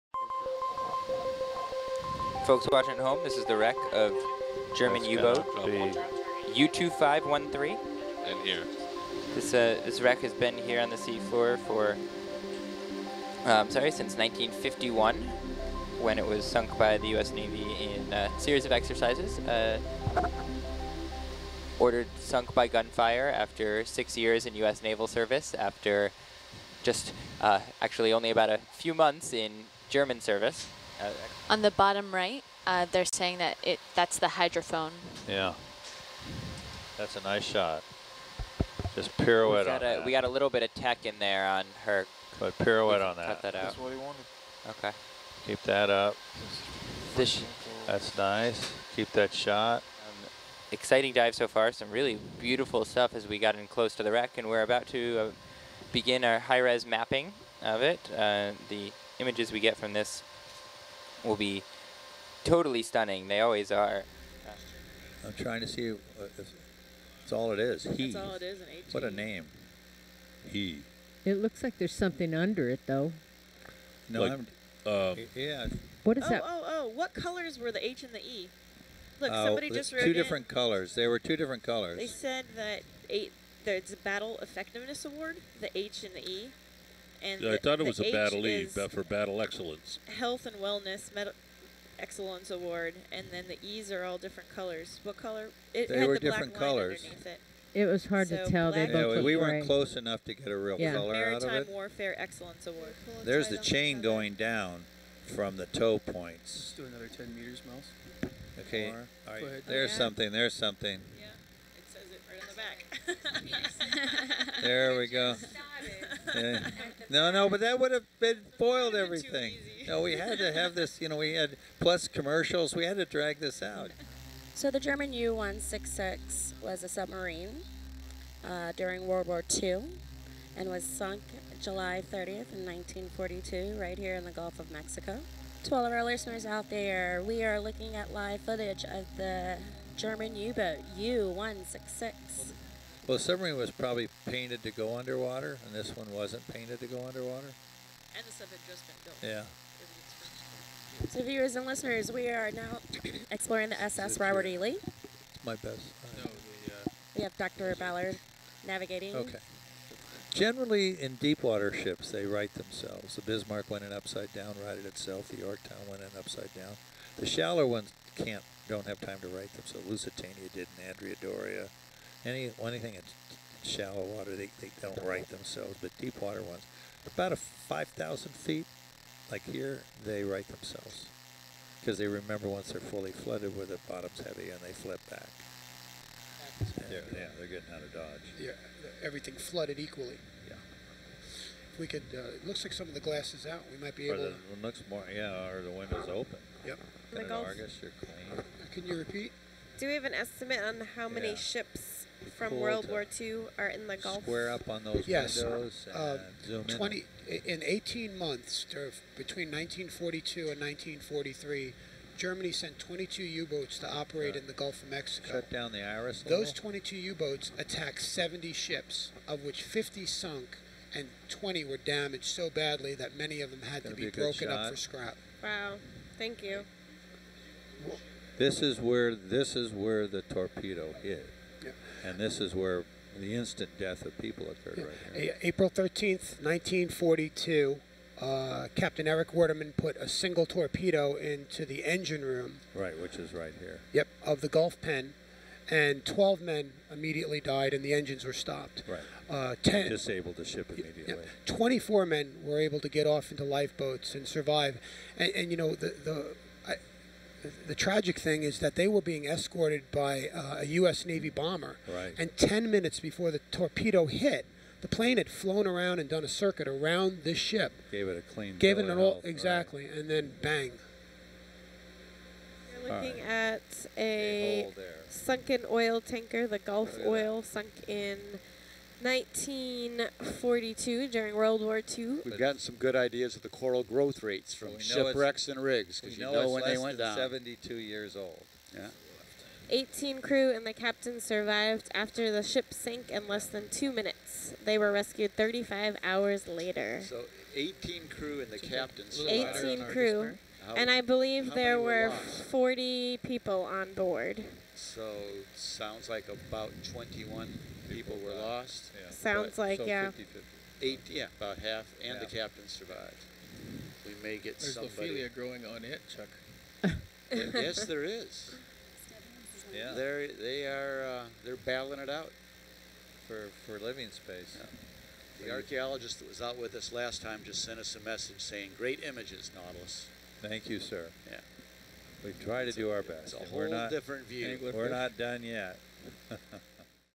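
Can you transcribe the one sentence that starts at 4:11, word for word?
Yeah, 24 men were able to get off into lifeboats and survive.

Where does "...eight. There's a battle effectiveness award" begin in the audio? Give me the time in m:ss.
1:23.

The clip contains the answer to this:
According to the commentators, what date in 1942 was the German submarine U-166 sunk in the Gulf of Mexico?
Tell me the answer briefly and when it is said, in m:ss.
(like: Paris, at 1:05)
July 30th, at 2:11.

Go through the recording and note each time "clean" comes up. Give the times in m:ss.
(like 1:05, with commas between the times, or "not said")
3:17, 4:28.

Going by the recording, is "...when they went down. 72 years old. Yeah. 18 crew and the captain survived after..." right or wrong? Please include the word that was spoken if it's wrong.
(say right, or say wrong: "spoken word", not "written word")
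right.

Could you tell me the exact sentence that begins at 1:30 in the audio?
Health and wellness med excellence award, and then the E's are all different colors.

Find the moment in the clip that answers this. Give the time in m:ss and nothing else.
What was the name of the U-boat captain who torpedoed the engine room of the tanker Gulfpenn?
3:59.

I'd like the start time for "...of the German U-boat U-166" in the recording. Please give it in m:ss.
2:18.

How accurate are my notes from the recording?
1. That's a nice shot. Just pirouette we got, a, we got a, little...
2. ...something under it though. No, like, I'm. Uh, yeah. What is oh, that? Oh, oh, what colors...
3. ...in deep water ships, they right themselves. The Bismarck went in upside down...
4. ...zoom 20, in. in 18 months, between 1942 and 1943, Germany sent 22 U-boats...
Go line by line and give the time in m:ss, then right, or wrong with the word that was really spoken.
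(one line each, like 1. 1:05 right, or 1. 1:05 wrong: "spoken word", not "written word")
1. 0:36 right
2. 1:11 right
3. 2:41 right
4. 3:26 right.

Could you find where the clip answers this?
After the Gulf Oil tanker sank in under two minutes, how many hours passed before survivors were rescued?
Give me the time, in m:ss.
4:55.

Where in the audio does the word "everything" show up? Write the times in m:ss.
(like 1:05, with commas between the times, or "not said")
1:59, 3:09.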